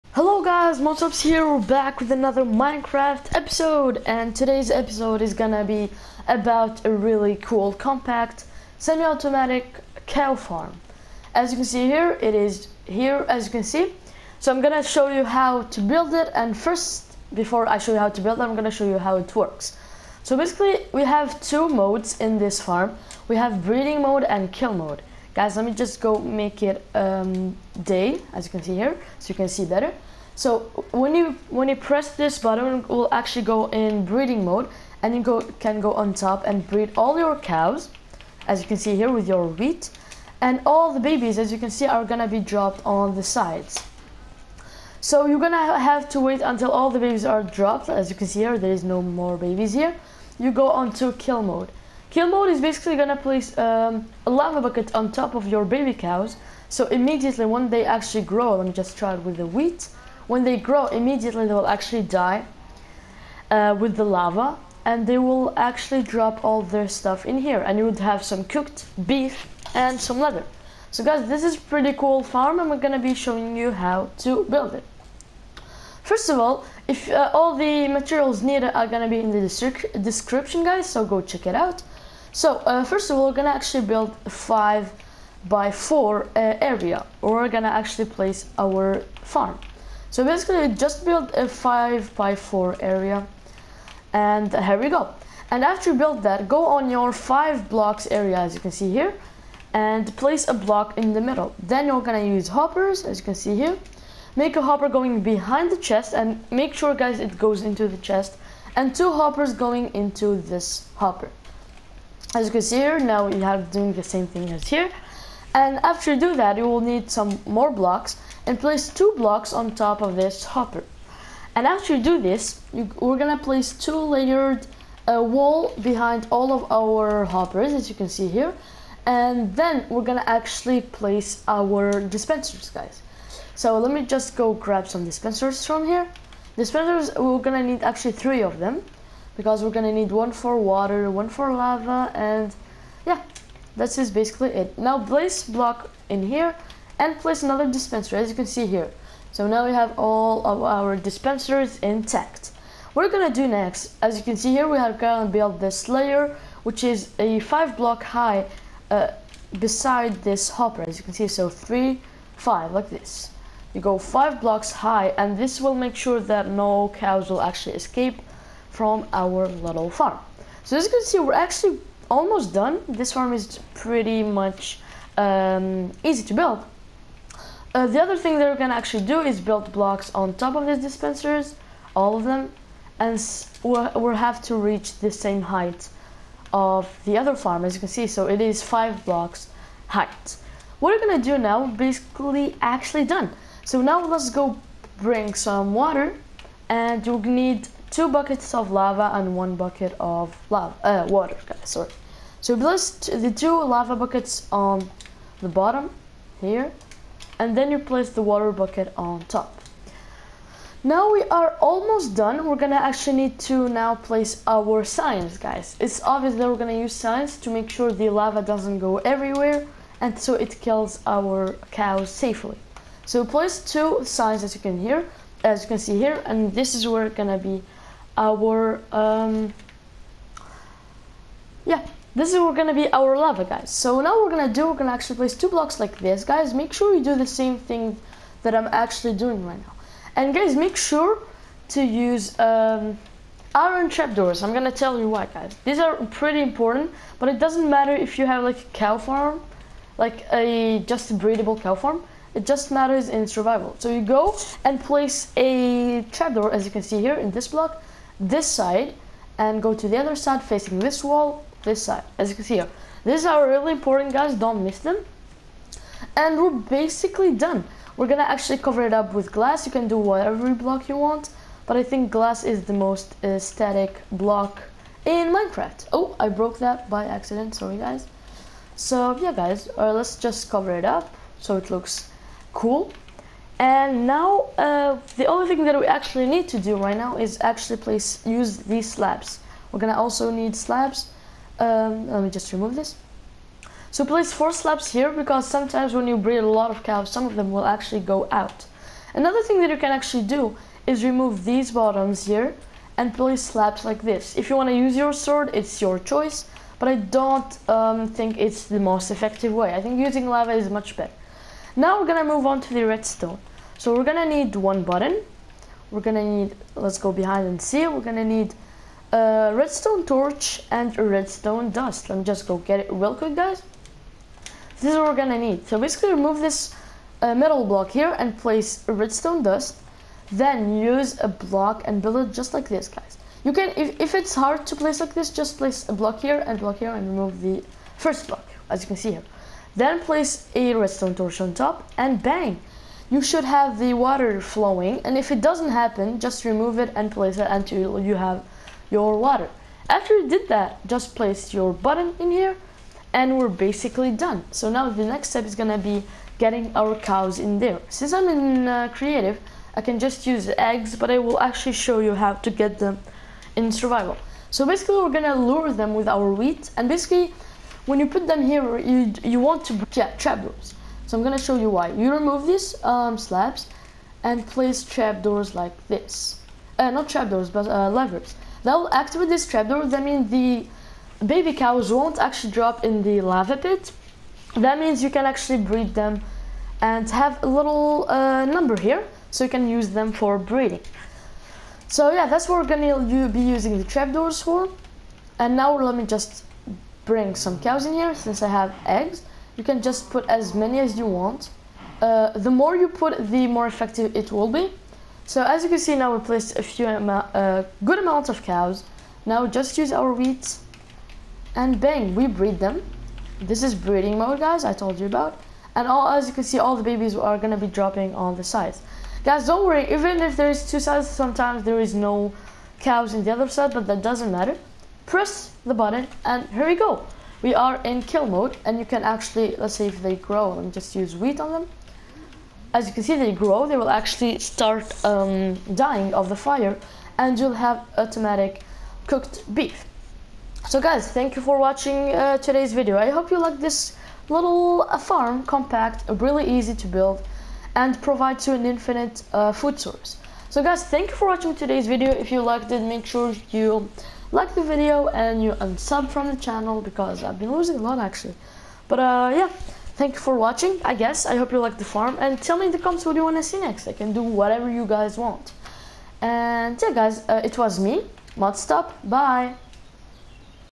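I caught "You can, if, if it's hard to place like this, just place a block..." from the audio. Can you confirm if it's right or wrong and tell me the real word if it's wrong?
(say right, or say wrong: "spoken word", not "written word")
right.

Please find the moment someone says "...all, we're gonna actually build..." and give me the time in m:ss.
1:23.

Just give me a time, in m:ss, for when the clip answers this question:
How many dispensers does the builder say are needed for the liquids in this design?
2:18.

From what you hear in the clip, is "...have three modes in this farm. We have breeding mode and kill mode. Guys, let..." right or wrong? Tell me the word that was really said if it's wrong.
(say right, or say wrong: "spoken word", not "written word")
wrong: "two", not "three".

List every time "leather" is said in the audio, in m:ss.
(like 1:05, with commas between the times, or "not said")
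1:10.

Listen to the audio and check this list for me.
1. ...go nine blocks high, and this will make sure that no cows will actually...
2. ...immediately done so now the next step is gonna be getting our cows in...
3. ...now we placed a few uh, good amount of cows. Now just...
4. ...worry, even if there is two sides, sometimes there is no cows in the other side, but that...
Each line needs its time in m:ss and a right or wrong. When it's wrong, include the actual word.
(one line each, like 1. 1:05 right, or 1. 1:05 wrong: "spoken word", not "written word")
1. 2:43 wrong: "five", not "nine"
2. 5:53 wrong: "basically", not "immediately"
3. 6:45 right
4. 6:59 right.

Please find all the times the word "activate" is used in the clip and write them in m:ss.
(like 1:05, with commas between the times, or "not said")
6:18.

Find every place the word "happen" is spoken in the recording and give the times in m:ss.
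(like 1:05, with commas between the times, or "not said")
5:45.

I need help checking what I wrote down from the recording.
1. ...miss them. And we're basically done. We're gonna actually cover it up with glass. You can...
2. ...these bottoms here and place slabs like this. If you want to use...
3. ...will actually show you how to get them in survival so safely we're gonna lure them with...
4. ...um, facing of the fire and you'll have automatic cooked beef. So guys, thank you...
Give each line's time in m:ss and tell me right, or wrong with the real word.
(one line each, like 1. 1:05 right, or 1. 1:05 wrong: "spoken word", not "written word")
1. 4:24 right
2. 5:01 right
3. 6:01 wrong: "basically", not "safely"
4. 7:15 wrong: "dying", not "facing".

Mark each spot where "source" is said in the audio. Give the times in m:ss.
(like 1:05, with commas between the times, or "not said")
7:29.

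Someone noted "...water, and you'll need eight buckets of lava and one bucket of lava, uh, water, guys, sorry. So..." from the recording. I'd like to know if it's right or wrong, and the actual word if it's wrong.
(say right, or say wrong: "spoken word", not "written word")
wrong: "two", not "eight".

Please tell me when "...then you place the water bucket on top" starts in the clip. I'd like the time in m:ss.
3:27.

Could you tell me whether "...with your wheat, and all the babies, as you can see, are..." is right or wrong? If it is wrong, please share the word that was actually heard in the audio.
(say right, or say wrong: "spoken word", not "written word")
right.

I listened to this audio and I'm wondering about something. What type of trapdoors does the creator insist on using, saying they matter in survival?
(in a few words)
Iron trapdoors.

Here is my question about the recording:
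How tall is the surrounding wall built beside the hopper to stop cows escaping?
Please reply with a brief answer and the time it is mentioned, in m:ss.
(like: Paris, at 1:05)
5 blocks, at 2:37.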